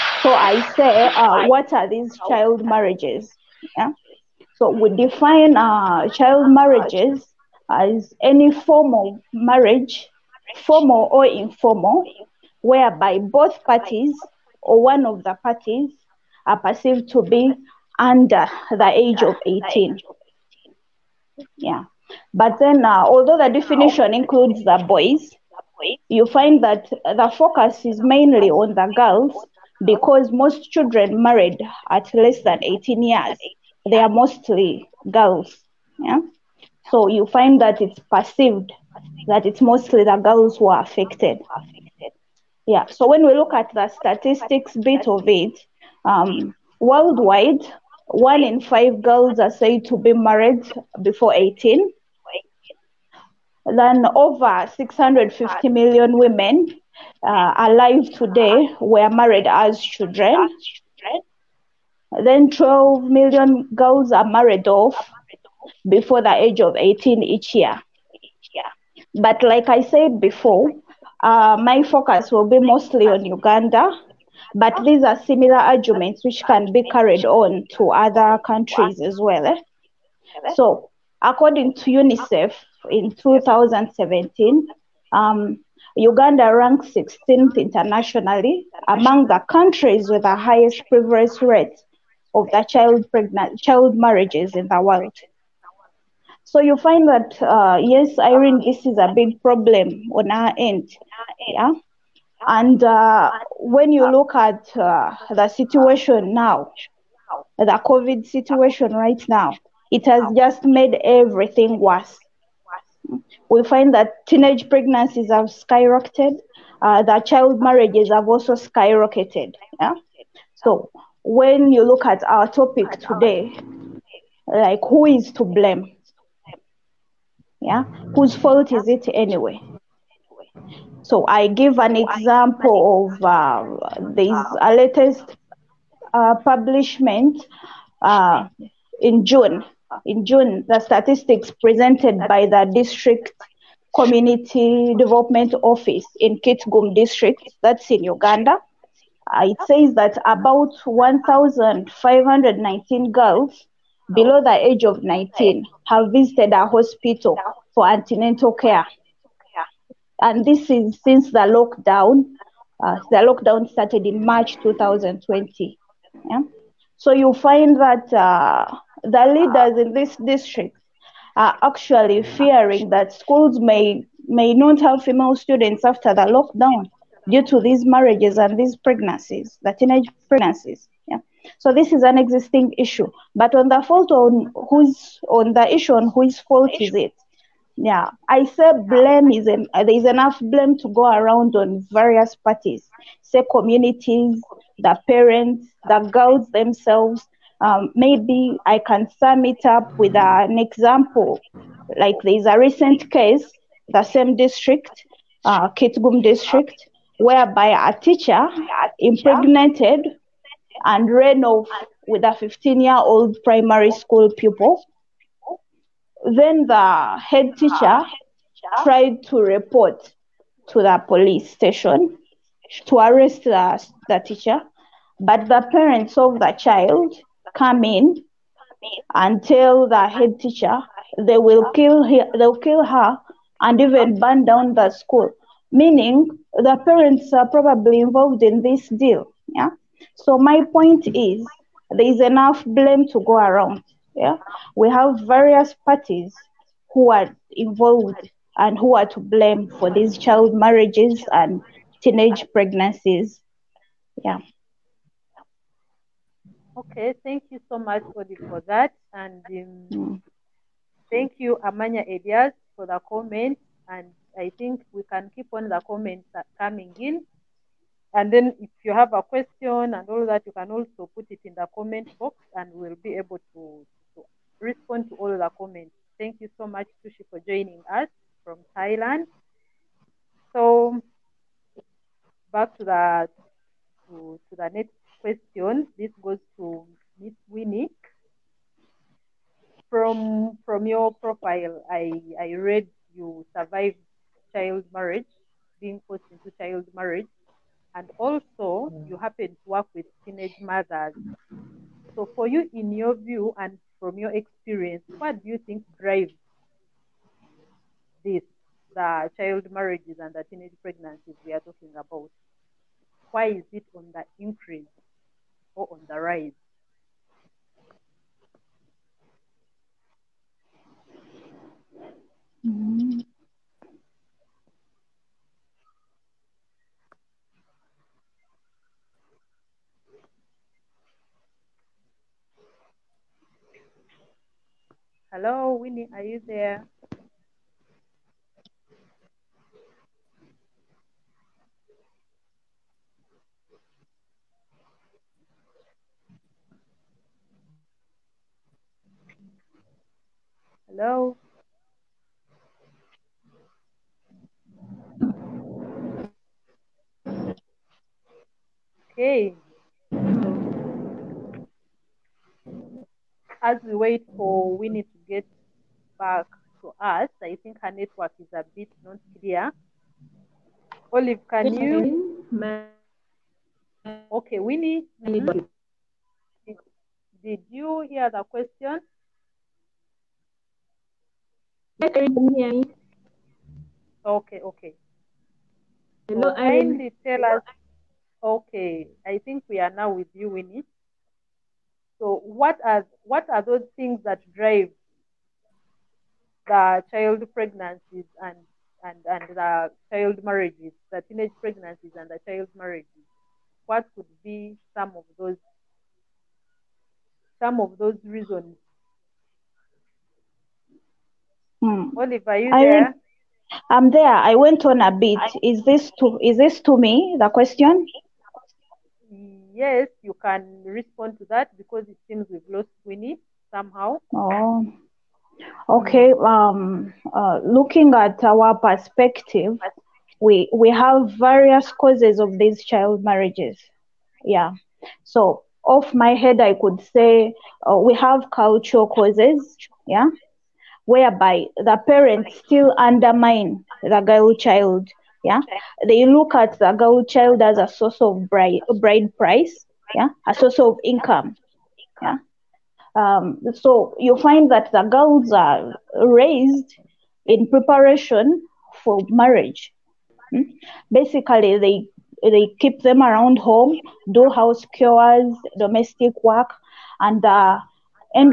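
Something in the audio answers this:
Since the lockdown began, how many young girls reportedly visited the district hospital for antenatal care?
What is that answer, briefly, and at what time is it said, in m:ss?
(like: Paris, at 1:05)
1519, at 2:30.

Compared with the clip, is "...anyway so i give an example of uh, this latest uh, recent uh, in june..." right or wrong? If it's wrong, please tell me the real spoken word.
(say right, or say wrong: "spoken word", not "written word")
wrong: "publishment", not "recent".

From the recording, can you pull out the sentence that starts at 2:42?
Uh, the lockdown started in March 2020.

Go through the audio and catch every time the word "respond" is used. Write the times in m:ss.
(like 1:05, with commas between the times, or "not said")
4:34, 7:00.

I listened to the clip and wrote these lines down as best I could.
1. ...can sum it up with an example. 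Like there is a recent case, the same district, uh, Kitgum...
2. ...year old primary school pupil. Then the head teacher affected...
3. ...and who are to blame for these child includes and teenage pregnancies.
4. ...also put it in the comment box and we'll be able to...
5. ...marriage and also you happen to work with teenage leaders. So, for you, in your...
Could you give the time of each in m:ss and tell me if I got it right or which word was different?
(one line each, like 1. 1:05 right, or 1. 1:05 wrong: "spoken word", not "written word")
1. 3:18 right
2. 3:32 wrong: "tried", not "affected"
3. 4:08 wrong: "marriages", not "includes"
4. 4:30 right
5. 4:56 wrong: "mothers", not "leaders".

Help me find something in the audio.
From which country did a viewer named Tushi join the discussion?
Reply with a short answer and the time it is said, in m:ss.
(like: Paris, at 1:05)
Thailand, at 4:38.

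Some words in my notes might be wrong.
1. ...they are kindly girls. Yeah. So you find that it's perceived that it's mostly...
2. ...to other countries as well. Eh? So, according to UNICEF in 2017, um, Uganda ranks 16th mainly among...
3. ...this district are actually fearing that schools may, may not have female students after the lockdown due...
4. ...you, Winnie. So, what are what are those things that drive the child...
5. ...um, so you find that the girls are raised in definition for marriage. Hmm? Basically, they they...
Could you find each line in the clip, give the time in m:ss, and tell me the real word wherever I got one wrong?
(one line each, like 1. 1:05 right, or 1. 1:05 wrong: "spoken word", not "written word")
1. 0:33 wrong: "mostly", not "kindly"
2. 1:17 wrong: "internationally", not "mainly"
3. 2:49 right
4. 6:30 right
5. 7:33 wrong: "preparation", not "definition".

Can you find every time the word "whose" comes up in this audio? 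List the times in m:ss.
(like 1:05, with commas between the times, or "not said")
2:08, 3:06.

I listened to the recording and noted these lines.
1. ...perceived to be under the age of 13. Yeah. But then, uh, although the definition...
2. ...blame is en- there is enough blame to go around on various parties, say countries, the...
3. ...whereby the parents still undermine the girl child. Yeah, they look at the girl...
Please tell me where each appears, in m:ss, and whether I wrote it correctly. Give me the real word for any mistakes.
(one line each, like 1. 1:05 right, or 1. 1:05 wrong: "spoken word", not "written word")
1. 0:16 wrong: "18", not "13"
2. 3:08 wrong: "communities", not "countries"
3. 7:21 right.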